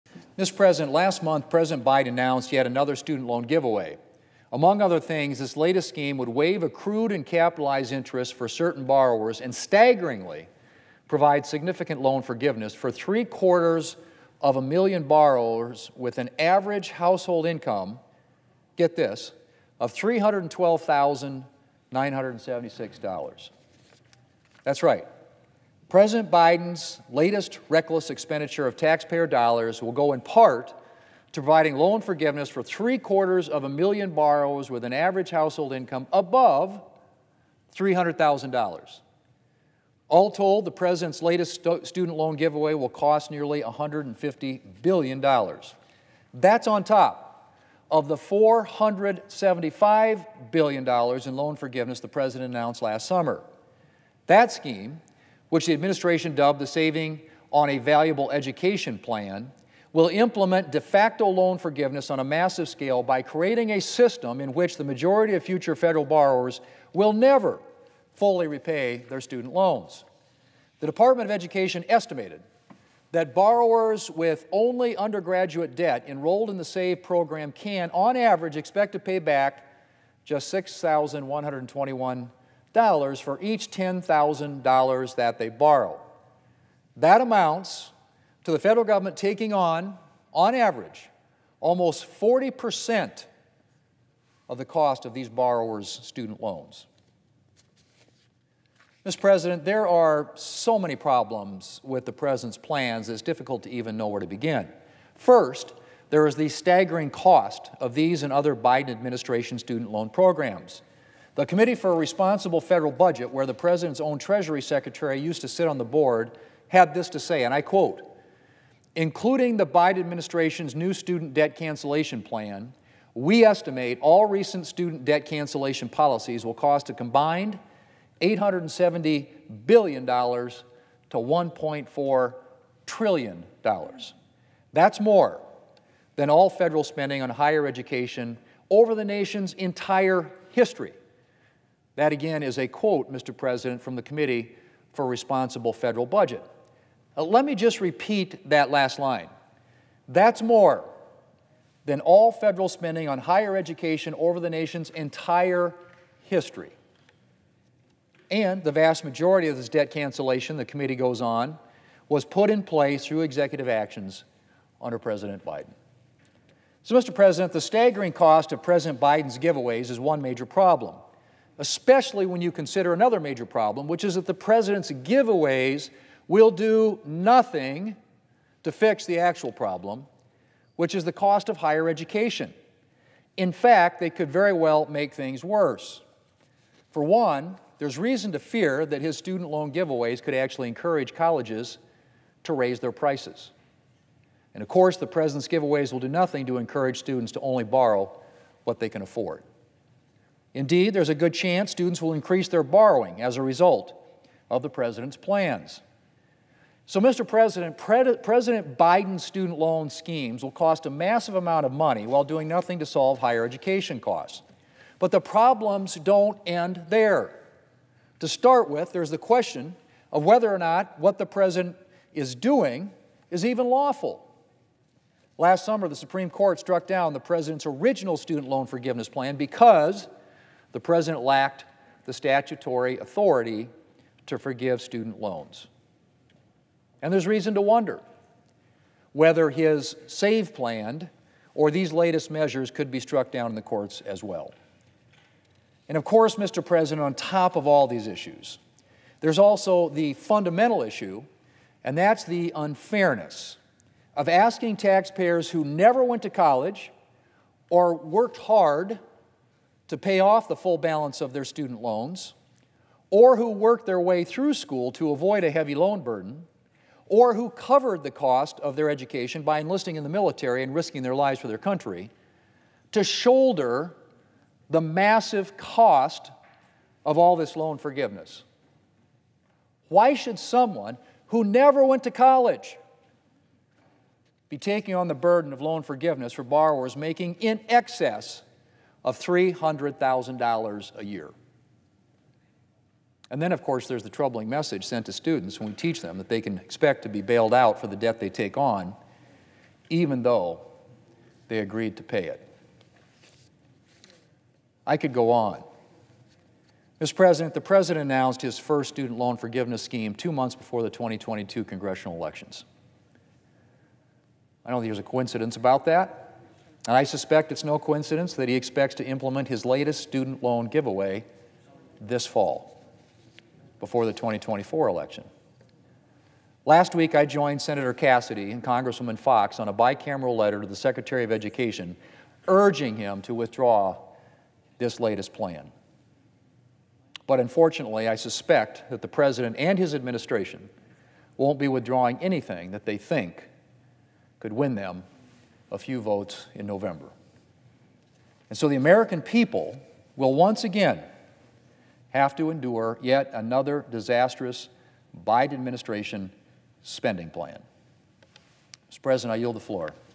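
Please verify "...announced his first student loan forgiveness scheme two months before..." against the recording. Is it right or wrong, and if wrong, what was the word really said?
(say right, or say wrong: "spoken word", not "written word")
right.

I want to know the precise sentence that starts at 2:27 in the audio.
Uh, let me just repeat that last line.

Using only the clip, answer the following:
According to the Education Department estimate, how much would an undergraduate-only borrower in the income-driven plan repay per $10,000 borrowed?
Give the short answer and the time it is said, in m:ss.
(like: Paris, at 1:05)
$6,121, at 1:20.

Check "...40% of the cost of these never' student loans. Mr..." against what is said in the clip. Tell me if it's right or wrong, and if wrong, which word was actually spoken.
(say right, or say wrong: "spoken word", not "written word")
wrong: "borrowers", not "never".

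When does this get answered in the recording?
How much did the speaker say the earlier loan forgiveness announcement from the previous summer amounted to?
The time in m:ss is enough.
0:48.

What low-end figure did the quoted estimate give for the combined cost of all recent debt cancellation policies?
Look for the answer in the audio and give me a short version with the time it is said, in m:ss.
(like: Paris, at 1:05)
$870 billion, at 2:08.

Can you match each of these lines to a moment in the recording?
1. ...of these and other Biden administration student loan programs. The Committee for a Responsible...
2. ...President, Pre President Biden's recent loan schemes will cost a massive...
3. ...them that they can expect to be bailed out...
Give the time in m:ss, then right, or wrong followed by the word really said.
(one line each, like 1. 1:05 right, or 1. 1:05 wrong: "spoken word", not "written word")
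1. 1:47 right
2. 3:27 wrong: "student", not "recent"
3. 4:56 right.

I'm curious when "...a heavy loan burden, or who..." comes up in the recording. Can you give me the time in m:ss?
4:25.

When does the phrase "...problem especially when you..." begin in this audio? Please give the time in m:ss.
2:50.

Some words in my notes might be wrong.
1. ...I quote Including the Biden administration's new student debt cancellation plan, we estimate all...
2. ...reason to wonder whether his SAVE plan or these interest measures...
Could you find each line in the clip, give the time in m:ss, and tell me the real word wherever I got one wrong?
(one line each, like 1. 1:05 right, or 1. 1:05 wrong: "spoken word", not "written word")
1. 1:57 right
2. 3:57 wrong: "latest", not "interest".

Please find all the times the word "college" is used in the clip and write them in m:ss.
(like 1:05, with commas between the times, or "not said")
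3:11, 4:16, 4:42.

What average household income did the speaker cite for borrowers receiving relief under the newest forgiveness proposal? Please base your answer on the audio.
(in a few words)
$312,976.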